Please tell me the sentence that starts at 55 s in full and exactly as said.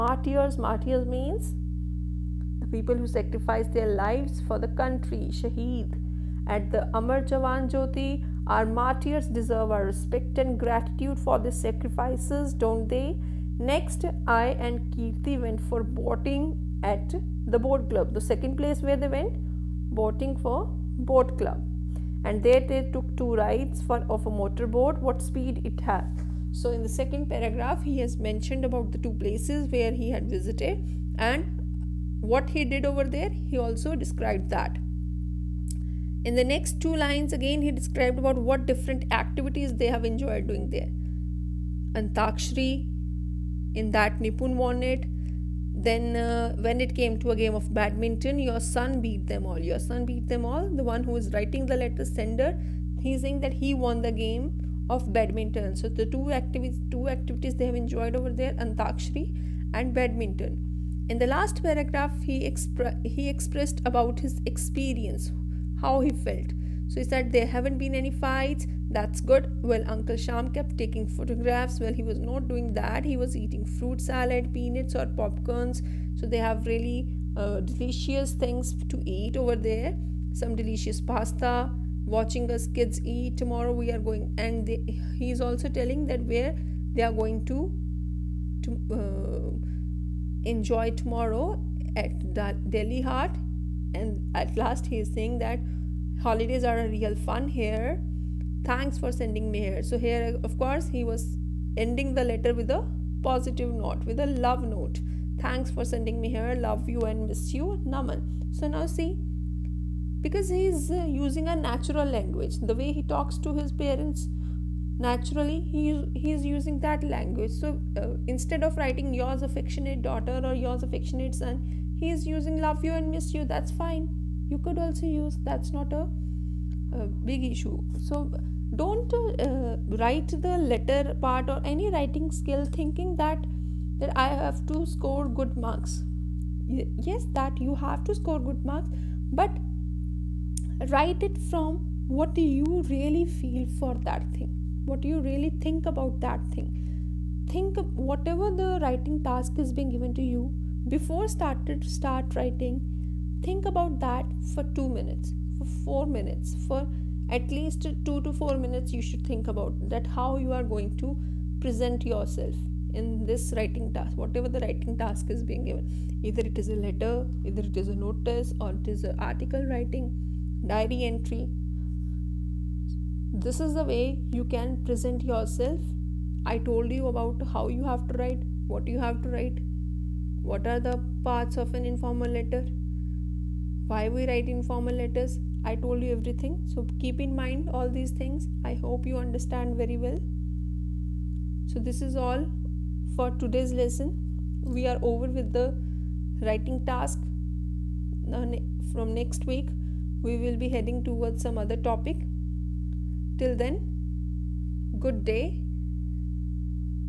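So the two activities, two activities they have enjoyed over there, Antakshri and badminton.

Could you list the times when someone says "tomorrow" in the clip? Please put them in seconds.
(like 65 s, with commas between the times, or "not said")
83 s, 90 s.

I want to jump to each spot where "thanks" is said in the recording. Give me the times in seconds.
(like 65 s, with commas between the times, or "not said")
98 s, 105 s.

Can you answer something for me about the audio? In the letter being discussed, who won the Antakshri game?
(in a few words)
Nipun.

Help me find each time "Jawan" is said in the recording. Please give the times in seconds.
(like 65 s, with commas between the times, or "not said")
7 s.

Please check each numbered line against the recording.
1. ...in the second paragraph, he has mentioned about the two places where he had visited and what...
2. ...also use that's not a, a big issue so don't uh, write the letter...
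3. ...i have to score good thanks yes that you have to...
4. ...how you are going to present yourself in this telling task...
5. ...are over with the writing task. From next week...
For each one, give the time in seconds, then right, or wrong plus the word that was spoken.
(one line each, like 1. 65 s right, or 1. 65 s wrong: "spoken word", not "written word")
1. 26 s right
2. 124 s right
3. 134 s wrong: "marks", not "thanks"
4. 160 s wrong: "writing", not "telling"
5. 194 s right.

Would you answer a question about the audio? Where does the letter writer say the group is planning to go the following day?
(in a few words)
Delhi Haat.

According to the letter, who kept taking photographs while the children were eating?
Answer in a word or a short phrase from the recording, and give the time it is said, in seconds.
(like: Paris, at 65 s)
Uncle Sham, at 69 s.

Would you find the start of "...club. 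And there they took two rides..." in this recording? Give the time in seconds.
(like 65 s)
21 s.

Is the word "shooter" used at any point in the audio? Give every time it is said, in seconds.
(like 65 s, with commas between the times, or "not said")
not said.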